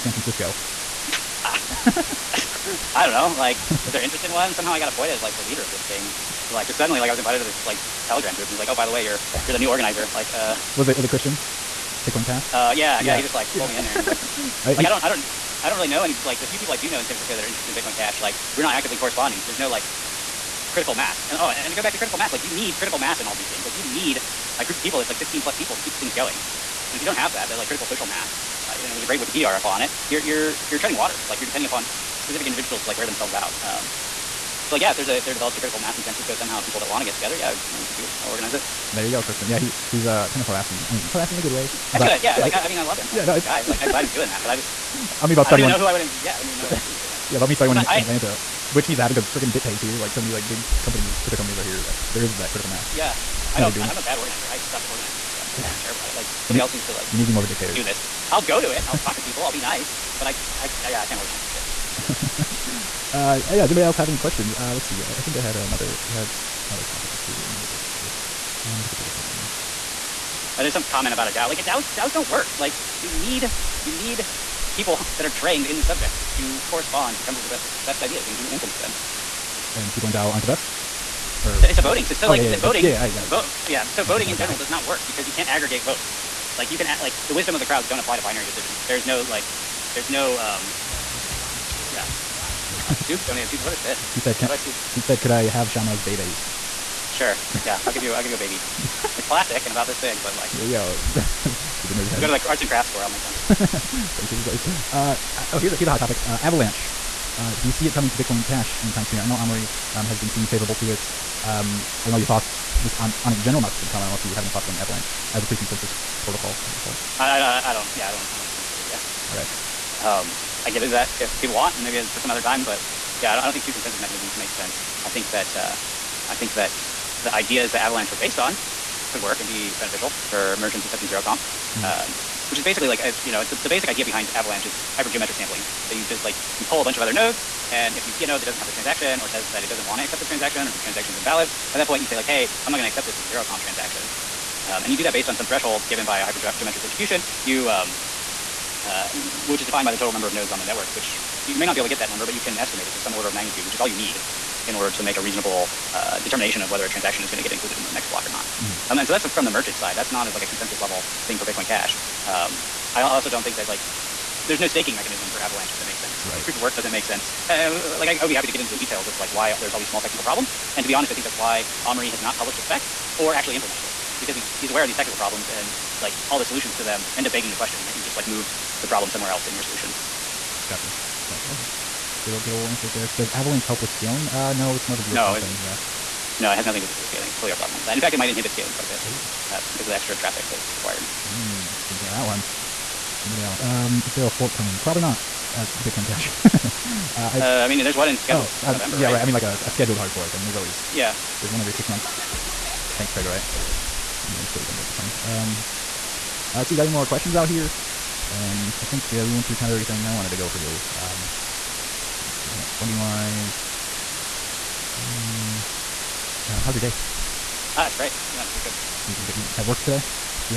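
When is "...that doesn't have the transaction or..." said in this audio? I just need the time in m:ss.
2:18.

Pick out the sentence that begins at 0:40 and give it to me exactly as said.
I mean, harassing in a good way.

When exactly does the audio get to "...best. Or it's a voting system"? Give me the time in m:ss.
1:20.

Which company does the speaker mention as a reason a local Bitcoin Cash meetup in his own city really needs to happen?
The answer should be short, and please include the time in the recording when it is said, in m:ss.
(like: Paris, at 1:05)
BitPay, at 0:49.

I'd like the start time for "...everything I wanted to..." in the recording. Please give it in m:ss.
3:29.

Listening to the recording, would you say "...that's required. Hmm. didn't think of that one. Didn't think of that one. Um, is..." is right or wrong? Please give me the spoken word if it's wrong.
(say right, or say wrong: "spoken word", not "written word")
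right.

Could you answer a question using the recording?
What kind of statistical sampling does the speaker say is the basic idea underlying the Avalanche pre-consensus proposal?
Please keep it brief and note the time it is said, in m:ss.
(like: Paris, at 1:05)
Hypergeometric sampling, at 2:14.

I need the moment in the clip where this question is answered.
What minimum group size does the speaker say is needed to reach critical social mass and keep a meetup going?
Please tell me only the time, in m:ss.
0:25.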